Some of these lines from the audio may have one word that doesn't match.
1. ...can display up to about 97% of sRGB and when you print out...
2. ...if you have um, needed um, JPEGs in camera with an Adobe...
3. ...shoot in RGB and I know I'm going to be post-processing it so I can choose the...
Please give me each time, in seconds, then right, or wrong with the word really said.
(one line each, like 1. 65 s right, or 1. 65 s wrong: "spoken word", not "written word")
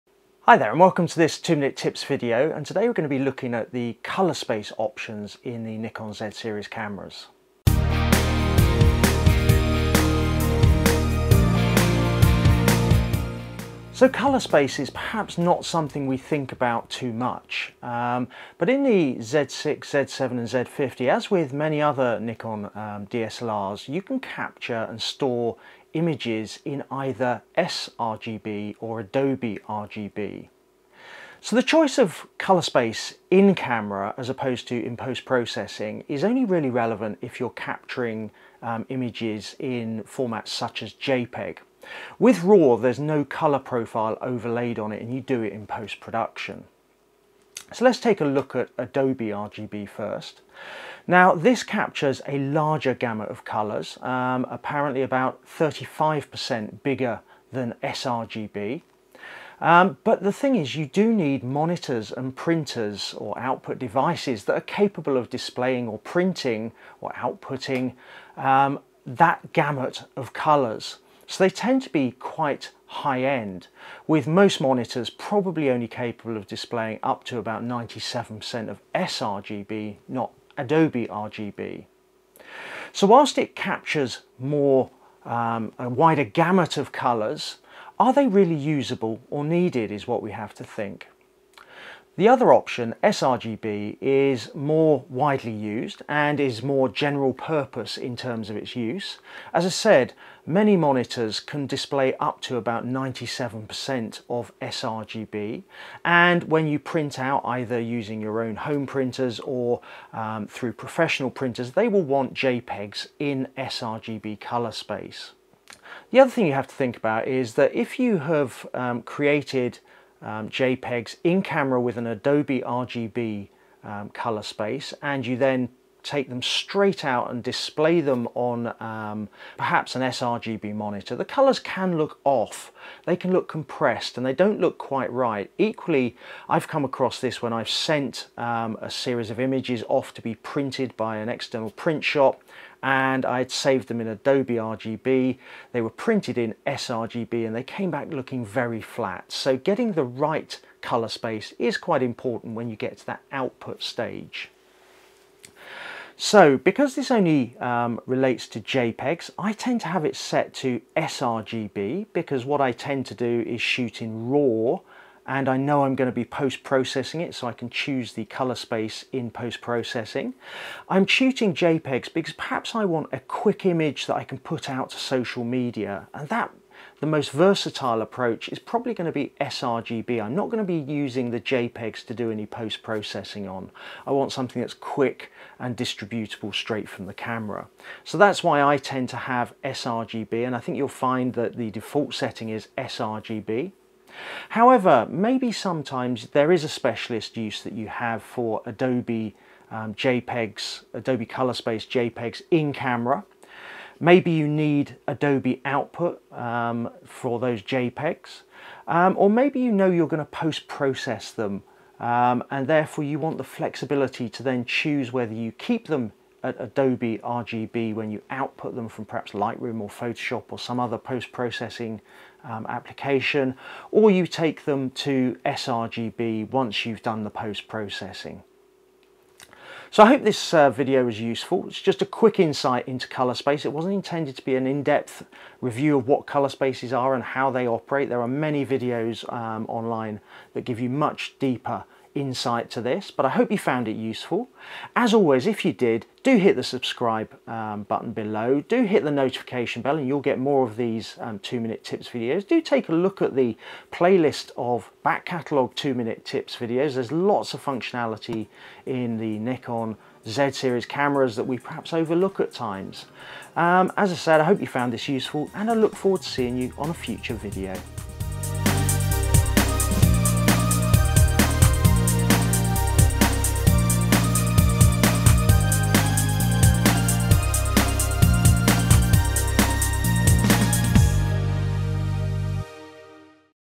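1. 101 s right
2. 117 s wrong: "created", not "needed"
3. 163 s wrong: "RAW", not "RGB".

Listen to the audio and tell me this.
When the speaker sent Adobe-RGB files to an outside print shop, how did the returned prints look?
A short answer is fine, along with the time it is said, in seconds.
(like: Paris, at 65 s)
very flat, at 148 s.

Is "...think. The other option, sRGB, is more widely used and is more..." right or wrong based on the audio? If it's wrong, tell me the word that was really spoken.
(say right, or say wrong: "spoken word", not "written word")
right.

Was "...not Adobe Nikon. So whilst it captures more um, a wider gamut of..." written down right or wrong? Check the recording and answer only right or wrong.
wrong.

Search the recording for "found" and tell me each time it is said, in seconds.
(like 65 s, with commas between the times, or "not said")
243 s, 264 s.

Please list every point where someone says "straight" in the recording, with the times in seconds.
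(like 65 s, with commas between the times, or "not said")
126 s, 186 s.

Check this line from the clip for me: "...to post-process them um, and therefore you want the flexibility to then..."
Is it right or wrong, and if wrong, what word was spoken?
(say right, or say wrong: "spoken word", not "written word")
right.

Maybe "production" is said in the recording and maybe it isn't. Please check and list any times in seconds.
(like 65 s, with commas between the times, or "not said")
45 s.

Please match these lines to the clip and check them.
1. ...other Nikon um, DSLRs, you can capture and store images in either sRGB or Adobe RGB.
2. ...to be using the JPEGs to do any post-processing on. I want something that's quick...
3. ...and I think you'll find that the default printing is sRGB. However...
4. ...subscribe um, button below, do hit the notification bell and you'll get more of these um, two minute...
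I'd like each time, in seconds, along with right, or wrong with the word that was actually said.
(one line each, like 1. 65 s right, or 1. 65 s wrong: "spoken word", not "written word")
1. 21 s right
2. 180 s right
3. 190 s wrong: "setting", not "printing"
4. 246 s right.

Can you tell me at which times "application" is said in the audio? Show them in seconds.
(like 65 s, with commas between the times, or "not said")
222 s.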